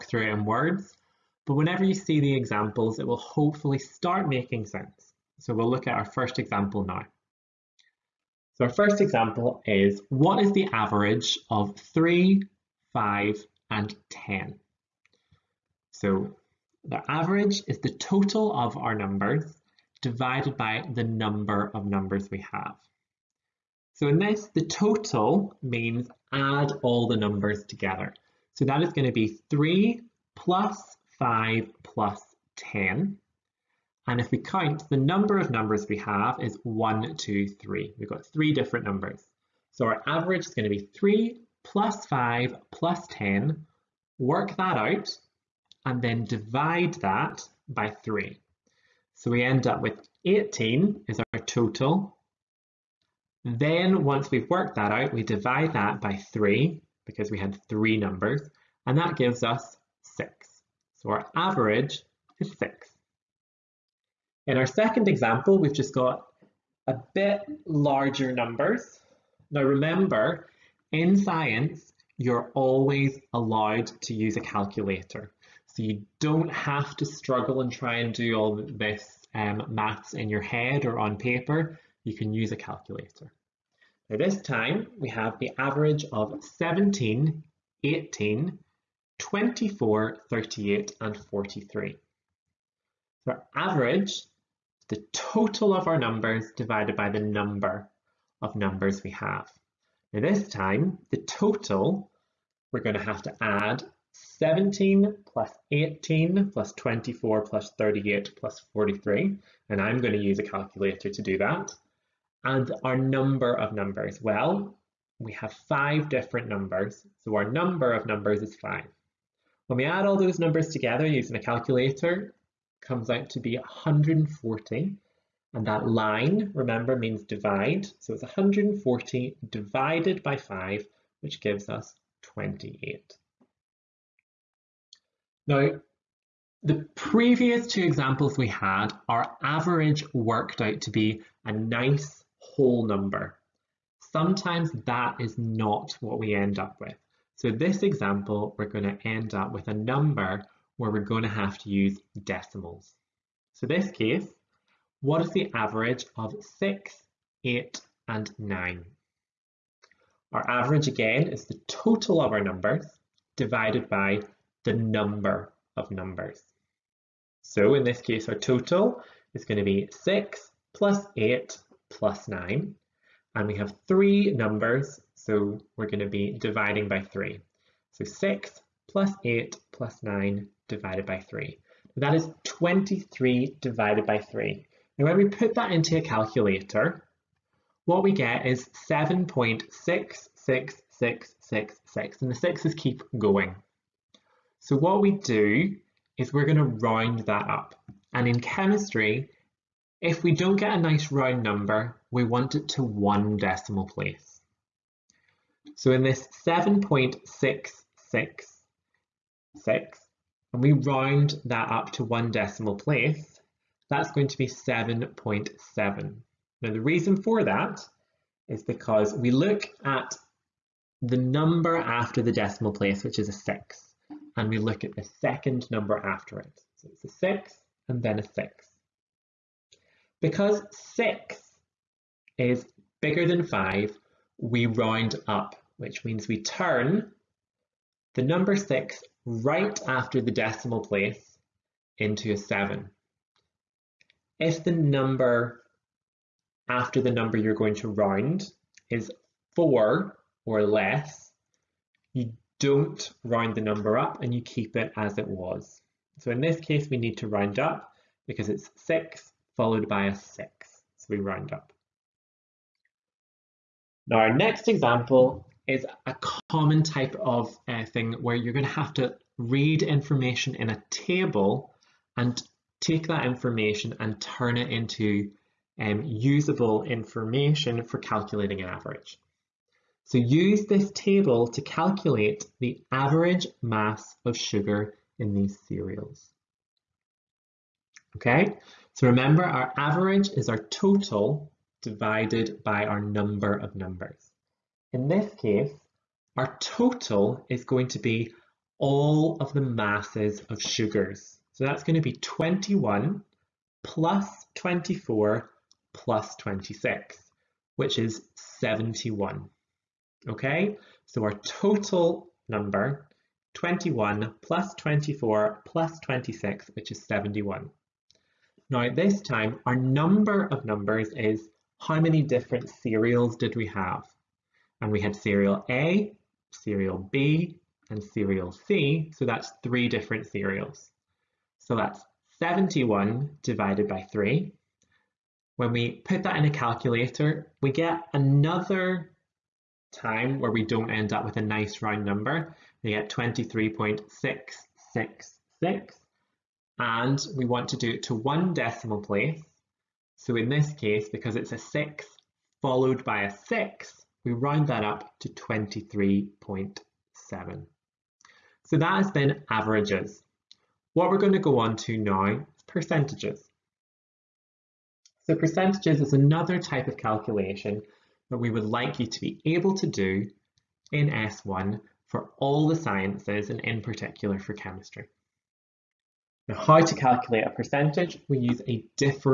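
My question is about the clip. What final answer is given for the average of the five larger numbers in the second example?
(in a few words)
28.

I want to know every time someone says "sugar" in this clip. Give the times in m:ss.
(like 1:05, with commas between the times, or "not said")
4:44, 5:00.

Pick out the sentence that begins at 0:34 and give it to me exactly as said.
And if we count, the number of numbers we have is 1, 2, 3.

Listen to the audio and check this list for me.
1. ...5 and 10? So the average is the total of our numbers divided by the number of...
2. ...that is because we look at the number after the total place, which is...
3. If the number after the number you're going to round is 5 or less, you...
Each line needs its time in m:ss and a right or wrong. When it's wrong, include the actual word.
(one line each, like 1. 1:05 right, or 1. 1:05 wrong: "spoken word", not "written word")
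1. 0:12 right
2. 3:37 wrong: "decimal", not "total"
3. 4:04 wrong: "4", not "5".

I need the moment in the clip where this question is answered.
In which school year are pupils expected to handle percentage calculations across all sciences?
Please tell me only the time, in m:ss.
6:11.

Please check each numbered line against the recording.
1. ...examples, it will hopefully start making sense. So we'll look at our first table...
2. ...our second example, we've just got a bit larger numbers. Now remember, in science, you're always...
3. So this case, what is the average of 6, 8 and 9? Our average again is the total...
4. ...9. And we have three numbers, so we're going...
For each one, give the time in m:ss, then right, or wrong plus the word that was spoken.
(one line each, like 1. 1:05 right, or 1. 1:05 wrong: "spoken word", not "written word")
1. 0:02 wrong: "example", not "table"
2. 1:04 right
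3. 2:33 right
4. 2:52 right.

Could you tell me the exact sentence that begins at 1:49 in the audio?
And I'm going to use a calculator to do that.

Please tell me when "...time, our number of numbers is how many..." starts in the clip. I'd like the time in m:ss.
5:19.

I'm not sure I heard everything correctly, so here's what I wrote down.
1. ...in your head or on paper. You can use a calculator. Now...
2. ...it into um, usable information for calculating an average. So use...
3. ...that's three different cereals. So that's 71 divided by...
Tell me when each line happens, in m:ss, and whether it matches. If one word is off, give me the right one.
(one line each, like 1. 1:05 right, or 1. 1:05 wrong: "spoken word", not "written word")
1. 1:20 right
2. 4:34 right
3. 5:29 right.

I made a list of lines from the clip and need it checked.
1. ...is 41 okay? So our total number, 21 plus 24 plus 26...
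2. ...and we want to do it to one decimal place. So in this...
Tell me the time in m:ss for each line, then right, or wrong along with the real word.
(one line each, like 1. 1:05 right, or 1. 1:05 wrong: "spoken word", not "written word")
1. 5:07 wrong: "71", not "41"
2. 5:46 right.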